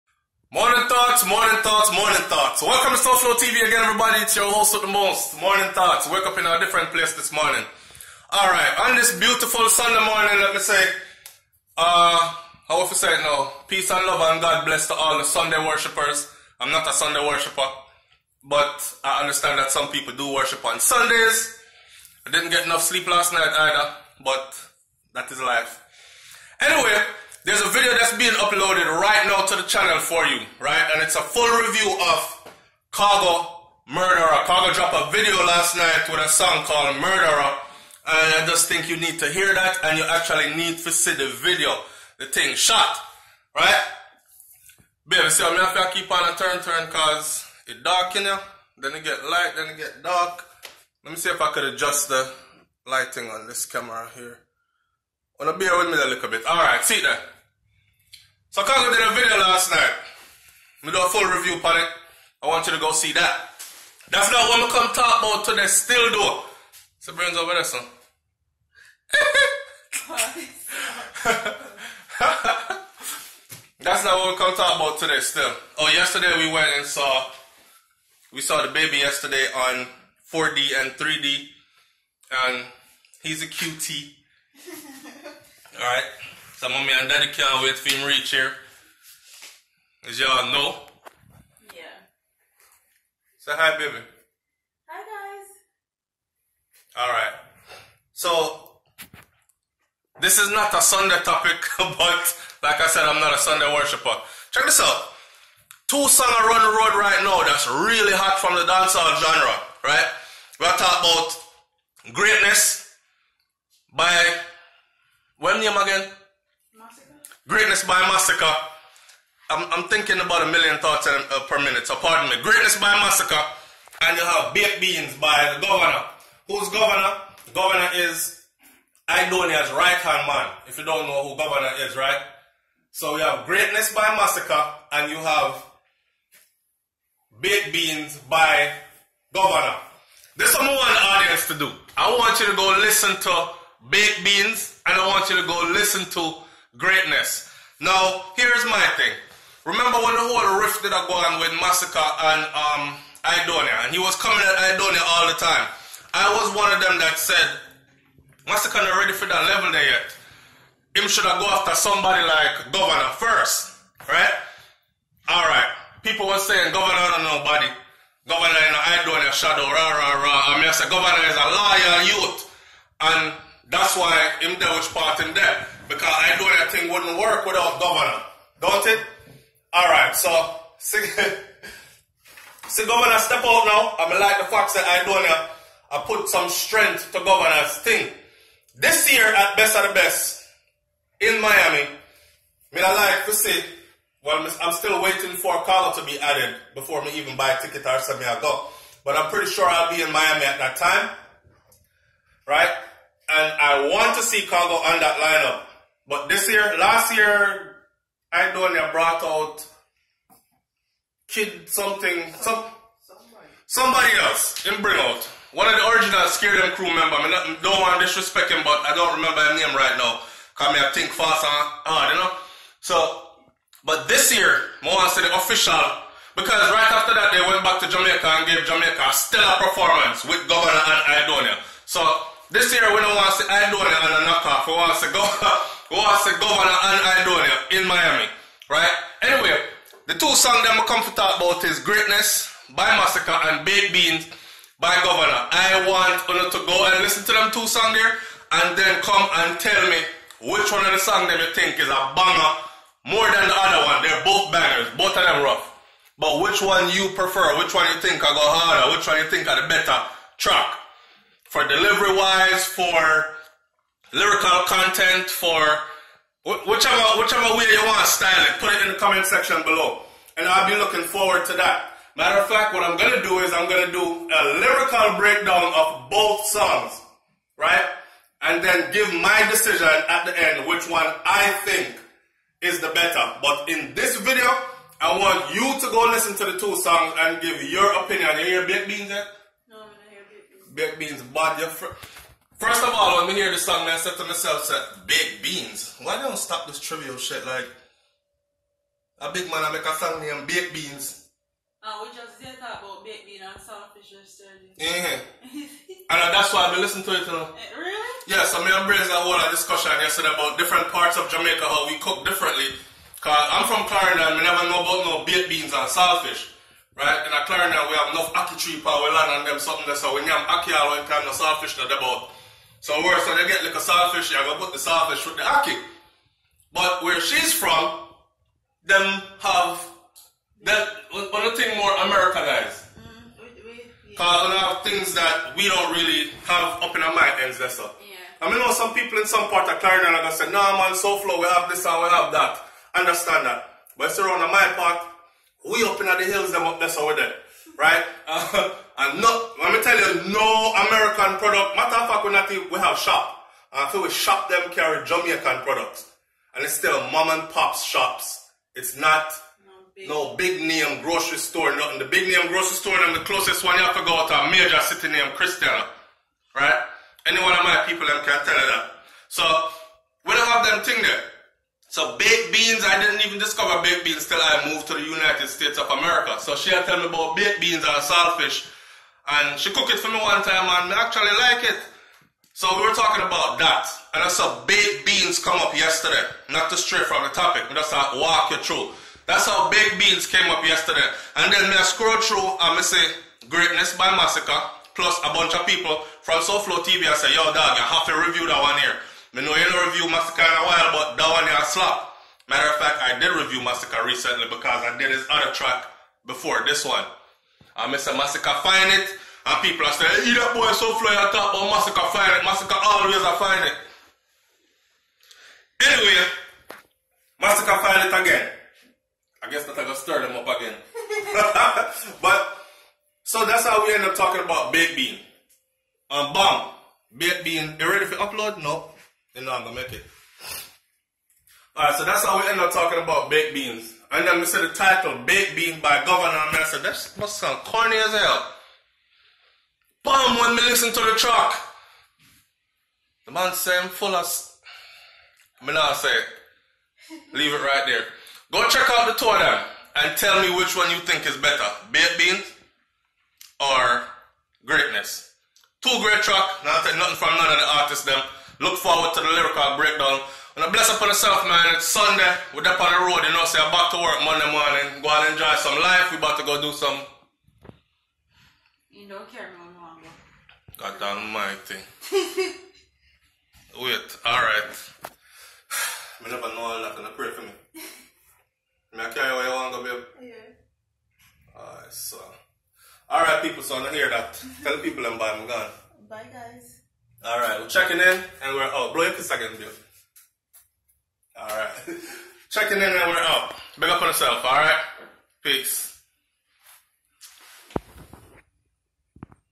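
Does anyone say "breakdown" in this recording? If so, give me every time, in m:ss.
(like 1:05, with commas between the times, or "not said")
4:35, 7:39.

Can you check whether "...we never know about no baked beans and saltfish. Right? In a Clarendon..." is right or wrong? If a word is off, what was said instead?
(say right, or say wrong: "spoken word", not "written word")
right.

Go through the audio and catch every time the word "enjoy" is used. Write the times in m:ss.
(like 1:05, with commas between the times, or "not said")
7:45.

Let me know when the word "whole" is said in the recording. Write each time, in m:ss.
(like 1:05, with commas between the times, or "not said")
2:30, 5:09.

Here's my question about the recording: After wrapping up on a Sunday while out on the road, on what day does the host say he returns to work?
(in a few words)
Monday.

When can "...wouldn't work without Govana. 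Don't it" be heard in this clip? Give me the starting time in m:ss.
2:56.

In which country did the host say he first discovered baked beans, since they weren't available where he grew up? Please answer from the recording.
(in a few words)
United States of America.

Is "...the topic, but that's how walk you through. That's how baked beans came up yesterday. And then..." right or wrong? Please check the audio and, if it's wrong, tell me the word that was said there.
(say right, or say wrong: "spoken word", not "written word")
right.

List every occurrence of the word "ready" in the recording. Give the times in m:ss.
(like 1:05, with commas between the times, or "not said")
2:39, 7:07.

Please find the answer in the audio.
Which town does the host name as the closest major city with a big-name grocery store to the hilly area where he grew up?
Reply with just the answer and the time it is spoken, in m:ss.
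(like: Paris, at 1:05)
Christiana, at 6:05.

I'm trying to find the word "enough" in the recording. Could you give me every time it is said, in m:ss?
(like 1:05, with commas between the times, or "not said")
0:22, 5:18.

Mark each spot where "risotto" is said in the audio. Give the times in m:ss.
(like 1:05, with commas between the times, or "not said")
not said.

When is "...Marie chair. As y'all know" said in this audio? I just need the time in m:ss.
1:28.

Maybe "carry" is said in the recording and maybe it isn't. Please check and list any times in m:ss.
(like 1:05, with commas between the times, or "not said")
5:54, 7:59.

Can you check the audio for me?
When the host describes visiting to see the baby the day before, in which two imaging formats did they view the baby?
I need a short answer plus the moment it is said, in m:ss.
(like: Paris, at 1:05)
4D and 3D, at 1:20.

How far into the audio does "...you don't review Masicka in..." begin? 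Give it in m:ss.
6:39.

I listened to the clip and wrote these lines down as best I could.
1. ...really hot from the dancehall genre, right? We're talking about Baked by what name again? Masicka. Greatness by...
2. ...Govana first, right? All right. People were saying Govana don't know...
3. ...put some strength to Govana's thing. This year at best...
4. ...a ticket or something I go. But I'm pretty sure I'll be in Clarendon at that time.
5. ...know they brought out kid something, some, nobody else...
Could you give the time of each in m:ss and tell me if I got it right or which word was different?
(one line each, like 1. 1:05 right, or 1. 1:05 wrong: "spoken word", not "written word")
1. 1:47 wrong: "Greatness", not "Baked"
2. 2:42 right
3. 3:06 right
4. 3:17 wrong: "Miami", not "Clarendon"
5. 3:28 wrong: "somebody", not "nobody".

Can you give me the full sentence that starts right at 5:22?
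So where so they get like a saltfish, you're gonna put the saltfish with the ackee.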